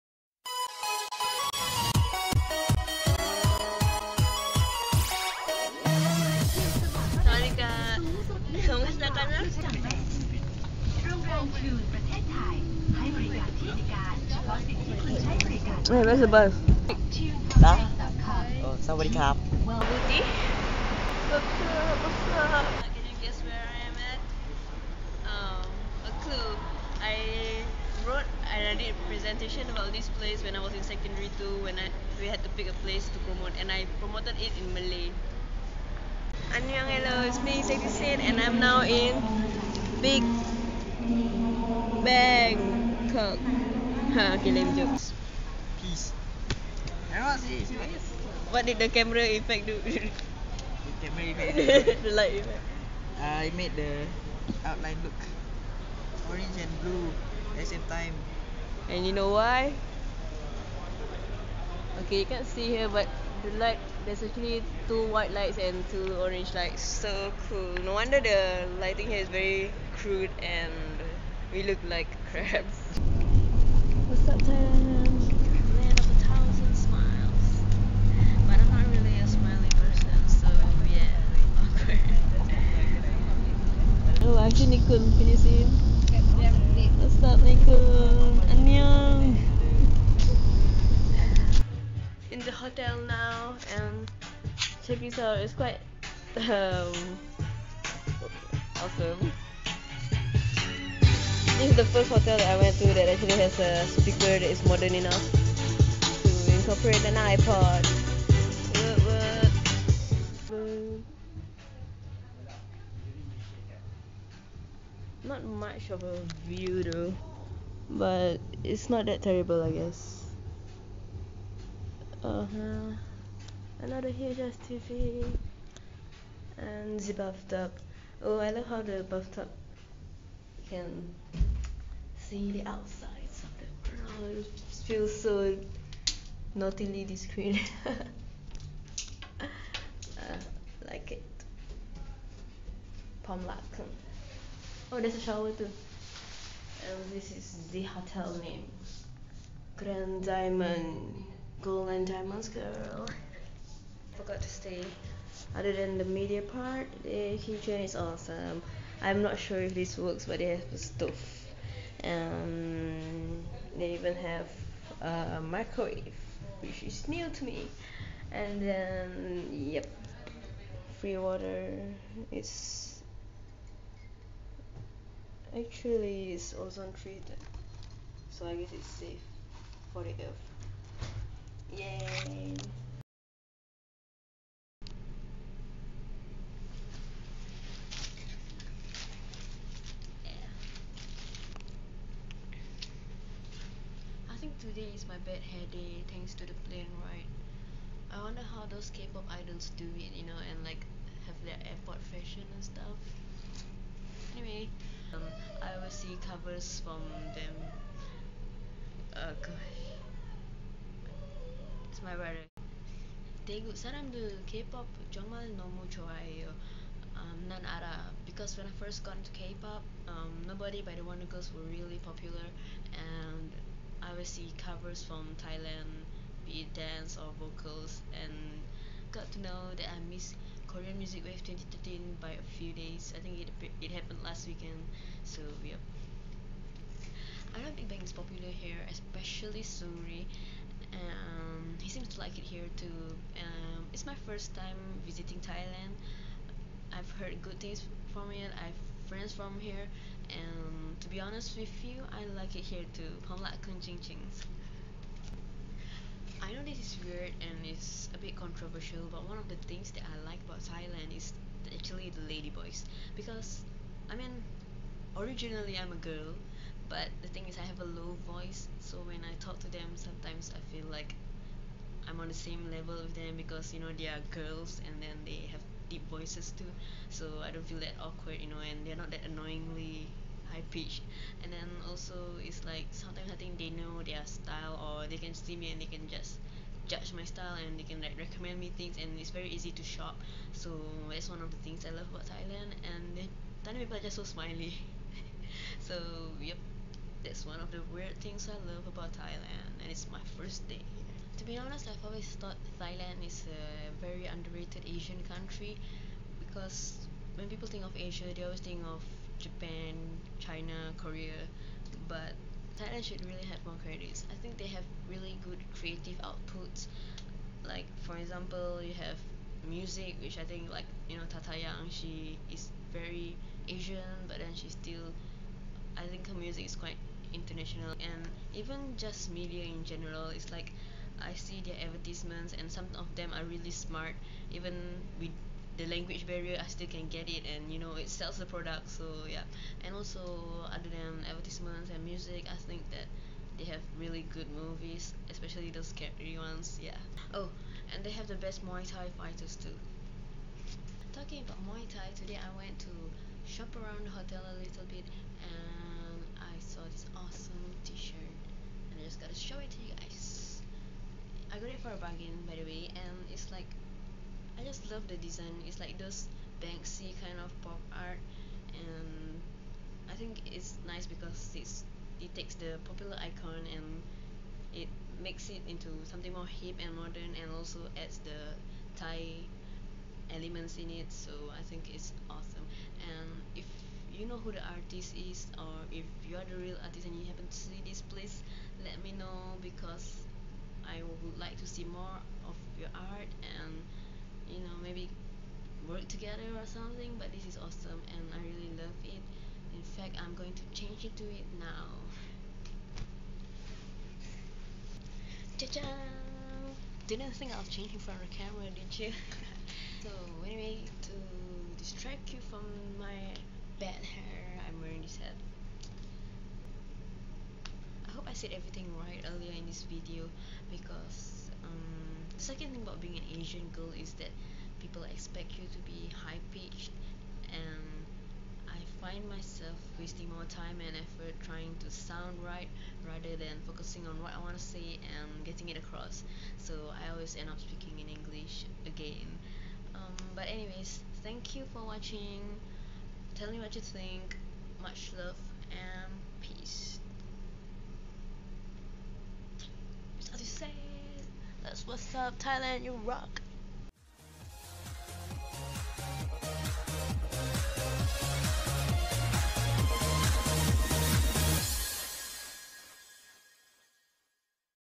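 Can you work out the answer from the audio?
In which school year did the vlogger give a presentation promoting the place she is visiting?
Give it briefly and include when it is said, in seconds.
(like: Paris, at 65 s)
Secondary two, at 30 s.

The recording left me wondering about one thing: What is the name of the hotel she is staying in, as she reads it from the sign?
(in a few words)
Grand Diamond.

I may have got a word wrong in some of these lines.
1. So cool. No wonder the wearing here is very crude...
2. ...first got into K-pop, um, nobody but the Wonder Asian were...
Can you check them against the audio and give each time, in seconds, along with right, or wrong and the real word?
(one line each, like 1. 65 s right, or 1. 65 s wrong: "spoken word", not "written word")
1. 66 s wrong: "lighting", not "wearing"
2. 218 s wrong: "Girls", not "Asian".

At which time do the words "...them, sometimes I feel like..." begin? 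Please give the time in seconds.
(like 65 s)
269 s.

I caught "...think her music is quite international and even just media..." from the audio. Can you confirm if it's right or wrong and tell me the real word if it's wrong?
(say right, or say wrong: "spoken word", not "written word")
right.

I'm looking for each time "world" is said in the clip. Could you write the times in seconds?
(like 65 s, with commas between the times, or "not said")
134 s.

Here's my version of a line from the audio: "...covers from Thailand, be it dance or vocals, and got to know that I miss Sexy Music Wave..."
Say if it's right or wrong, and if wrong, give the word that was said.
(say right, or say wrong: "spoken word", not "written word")
wrong: "Korean", not "Sexy".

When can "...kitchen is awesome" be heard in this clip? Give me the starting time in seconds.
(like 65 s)
157 s.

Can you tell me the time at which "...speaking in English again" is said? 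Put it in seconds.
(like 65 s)
437 s.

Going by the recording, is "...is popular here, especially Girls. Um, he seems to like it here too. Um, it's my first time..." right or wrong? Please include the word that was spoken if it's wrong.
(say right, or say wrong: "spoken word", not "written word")
wrong: "Suri", not "Girls".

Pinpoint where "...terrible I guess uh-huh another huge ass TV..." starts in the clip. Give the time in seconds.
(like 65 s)
119 s.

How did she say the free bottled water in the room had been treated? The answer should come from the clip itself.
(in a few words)
Ozone treated.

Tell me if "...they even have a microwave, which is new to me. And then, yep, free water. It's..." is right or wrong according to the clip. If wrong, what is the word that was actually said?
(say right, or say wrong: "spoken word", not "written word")
right.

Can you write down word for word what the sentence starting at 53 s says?
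Uh, I made the outline look orange and blue at the same time.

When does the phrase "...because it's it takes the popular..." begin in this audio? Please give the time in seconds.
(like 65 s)
371 s.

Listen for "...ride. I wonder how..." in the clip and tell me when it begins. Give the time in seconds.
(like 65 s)
197 s.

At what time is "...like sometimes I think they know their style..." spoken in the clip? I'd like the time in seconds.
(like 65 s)
282 s.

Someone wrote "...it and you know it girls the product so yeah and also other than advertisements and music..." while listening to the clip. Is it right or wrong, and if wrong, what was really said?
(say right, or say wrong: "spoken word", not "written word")
wrong: "sells", not "girls".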